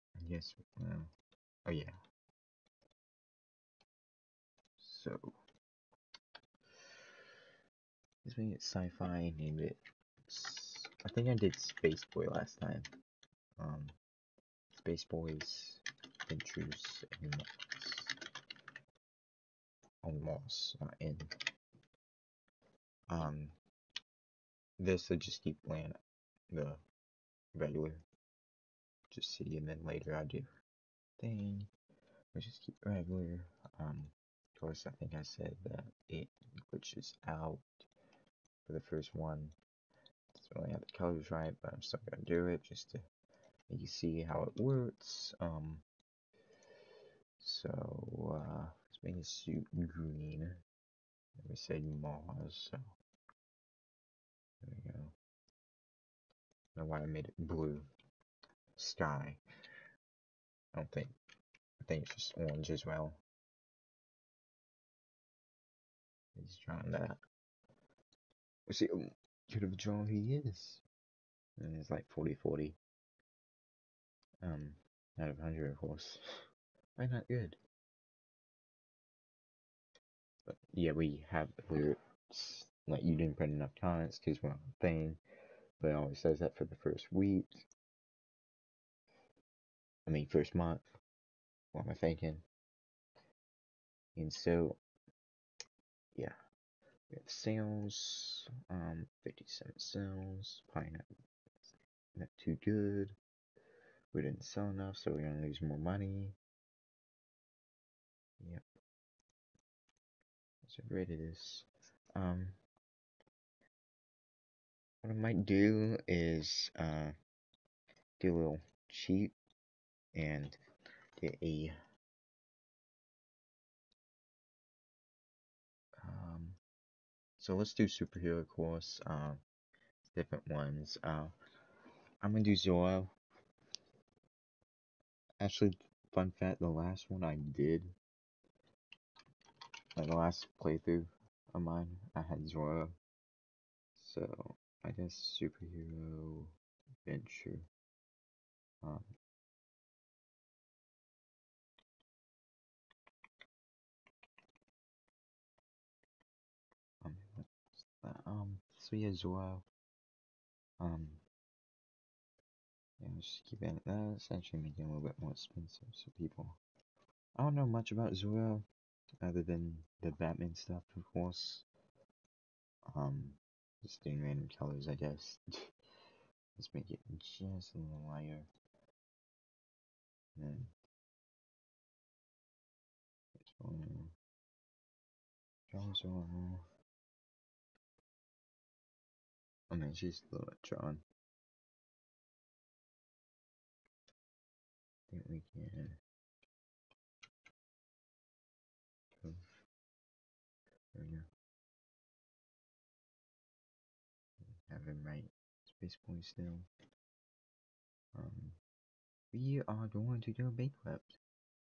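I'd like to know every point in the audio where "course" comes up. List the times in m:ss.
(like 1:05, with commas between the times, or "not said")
0:34, 1:15, 2:08, 2:51.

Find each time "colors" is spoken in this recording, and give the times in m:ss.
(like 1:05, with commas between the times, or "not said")
0:40, 2:54.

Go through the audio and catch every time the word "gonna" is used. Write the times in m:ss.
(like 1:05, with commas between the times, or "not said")
0:42, 1:45, 2:12.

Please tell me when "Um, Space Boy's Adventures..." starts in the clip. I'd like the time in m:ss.
0:13.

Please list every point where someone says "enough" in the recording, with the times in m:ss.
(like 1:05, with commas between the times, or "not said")
1:23, 1:44.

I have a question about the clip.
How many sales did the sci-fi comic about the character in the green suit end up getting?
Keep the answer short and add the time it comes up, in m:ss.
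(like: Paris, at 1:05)
57, at 1:39.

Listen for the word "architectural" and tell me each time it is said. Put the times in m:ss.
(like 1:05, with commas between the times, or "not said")
not said.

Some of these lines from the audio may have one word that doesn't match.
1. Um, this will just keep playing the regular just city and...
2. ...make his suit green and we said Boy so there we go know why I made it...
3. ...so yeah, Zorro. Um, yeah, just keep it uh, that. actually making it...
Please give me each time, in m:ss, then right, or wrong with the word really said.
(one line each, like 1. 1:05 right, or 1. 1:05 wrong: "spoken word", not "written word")
1. 0:23 right
2. 0:49 wrong: "Mars", not "Boy"
3. 2:38 right.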